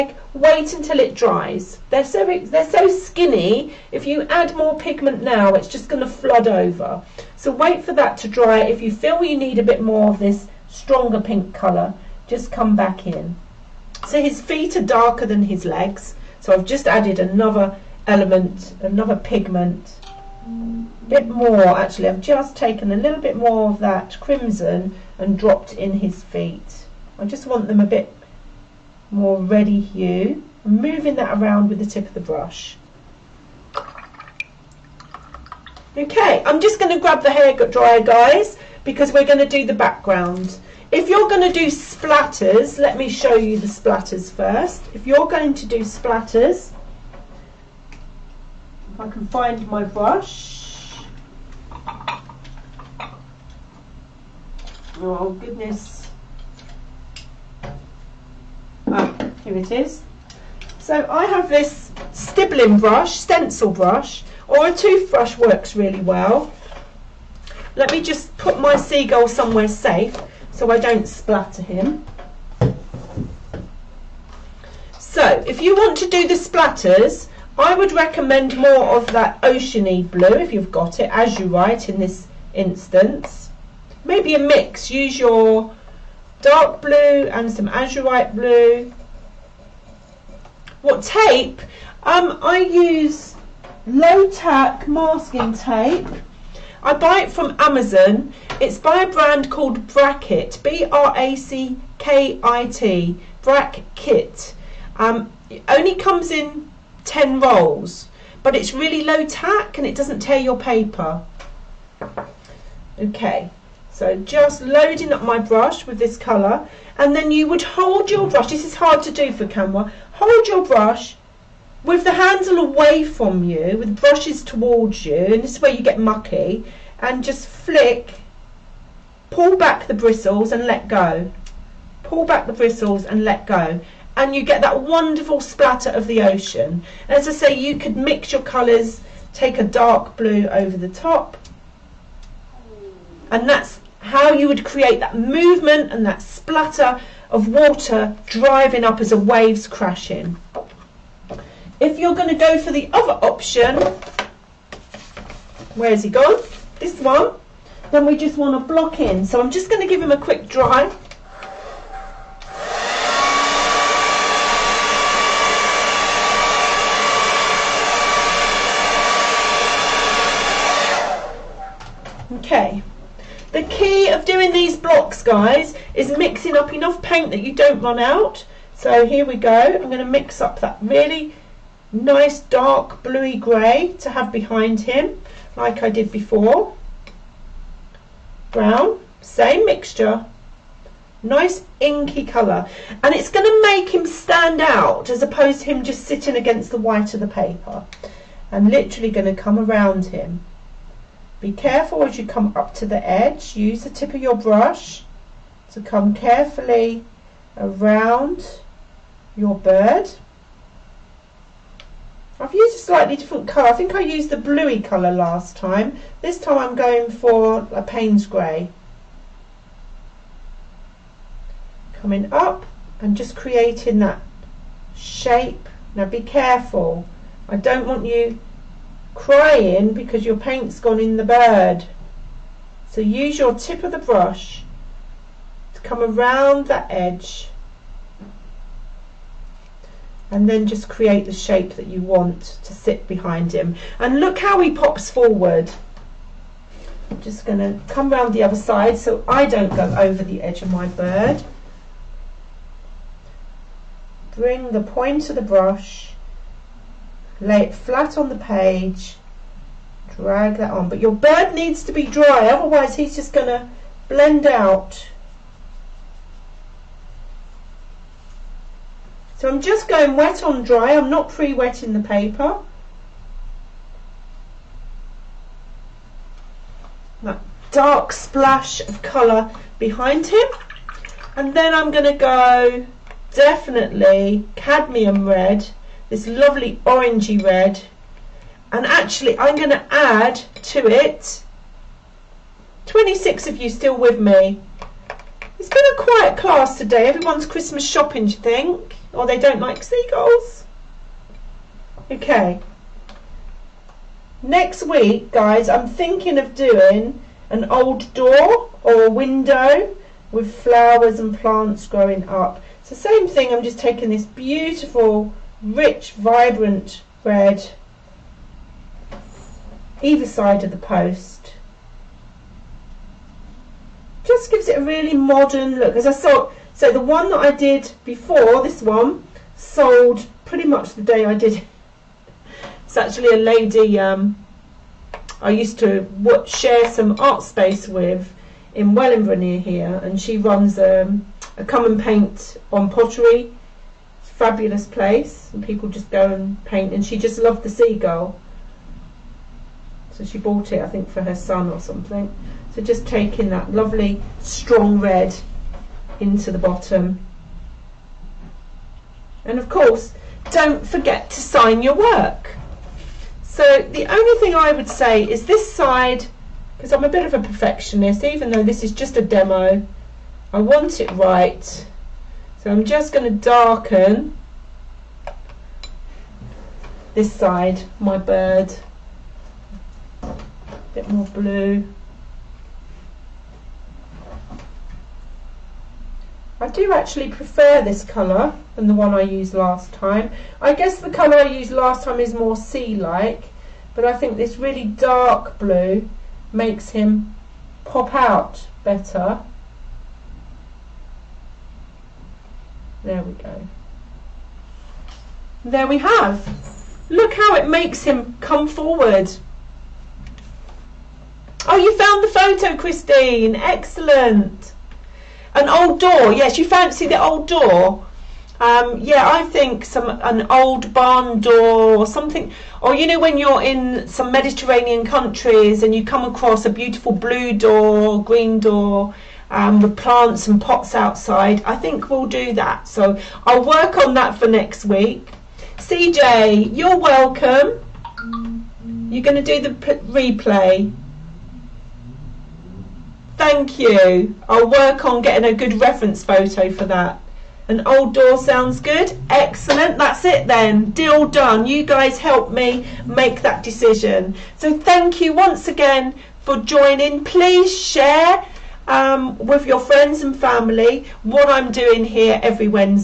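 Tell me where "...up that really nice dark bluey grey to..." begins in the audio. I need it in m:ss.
3:00.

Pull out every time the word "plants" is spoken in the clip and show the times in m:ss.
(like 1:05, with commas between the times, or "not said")
5:11, 7:09.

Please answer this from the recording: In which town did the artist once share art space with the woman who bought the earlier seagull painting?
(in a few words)
Wellingborough.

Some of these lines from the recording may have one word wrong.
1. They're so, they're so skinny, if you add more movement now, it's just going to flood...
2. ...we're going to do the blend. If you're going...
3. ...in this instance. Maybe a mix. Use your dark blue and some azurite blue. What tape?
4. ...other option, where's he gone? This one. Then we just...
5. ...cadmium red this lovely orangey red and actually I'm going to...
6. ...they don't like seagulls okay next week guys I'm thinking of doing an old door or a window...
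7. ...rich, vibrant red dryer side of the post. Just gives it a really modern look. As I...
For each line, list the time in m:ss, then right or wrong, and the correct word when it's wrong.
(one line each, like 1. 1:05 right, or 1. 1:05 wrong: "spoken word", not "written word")
1. 0:01 wrong: "pigment", not "movement"
2. 0:39 wrong: "background", not "blend"
3. 1:21 right
4. 2:32 right
5. 4:44 right
6. 4:59 right
7. 5:15 wrong: "either", not "dryer".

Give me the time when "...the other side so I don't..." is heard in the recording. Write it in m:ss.
4:08.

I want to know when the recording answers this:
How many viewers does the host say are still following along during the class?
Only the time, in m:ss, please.
4:52.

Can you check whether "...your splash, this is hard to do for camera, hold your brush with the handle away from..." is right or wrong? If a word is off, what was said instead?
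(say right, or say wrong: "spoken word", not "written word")
wrong: "brush", not "splash".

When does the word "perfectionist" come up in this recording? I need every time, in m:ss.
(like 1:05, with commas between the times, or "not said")
6:07.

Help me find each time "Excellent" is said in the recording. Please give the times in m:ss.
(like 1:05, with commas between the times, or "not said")
6:53, 7:29.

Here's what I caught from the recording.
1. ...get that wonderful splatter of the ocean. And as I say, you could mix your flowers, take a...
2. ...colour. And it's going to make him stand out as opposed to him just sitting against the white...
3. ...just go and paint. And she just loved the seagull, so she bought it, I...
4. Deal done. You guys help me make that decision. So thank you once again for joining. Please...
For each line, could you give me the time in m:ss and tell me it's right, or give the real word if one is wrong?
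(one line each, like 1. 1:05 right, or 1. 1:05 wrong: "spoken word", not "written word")
1. 2:14 wrong: "colours", not "flowers"
2. 3:12 right
3. 5:45 right
4. 7:30 right.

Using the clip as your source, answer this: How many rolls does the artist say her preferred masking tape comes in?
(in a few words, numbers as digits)
10.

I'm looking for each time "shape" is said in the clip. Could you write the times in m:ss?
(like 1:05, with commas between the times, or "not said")
3:44, 4:01.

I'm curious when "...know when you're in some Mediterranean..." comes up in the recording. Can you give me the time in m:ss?
7:03.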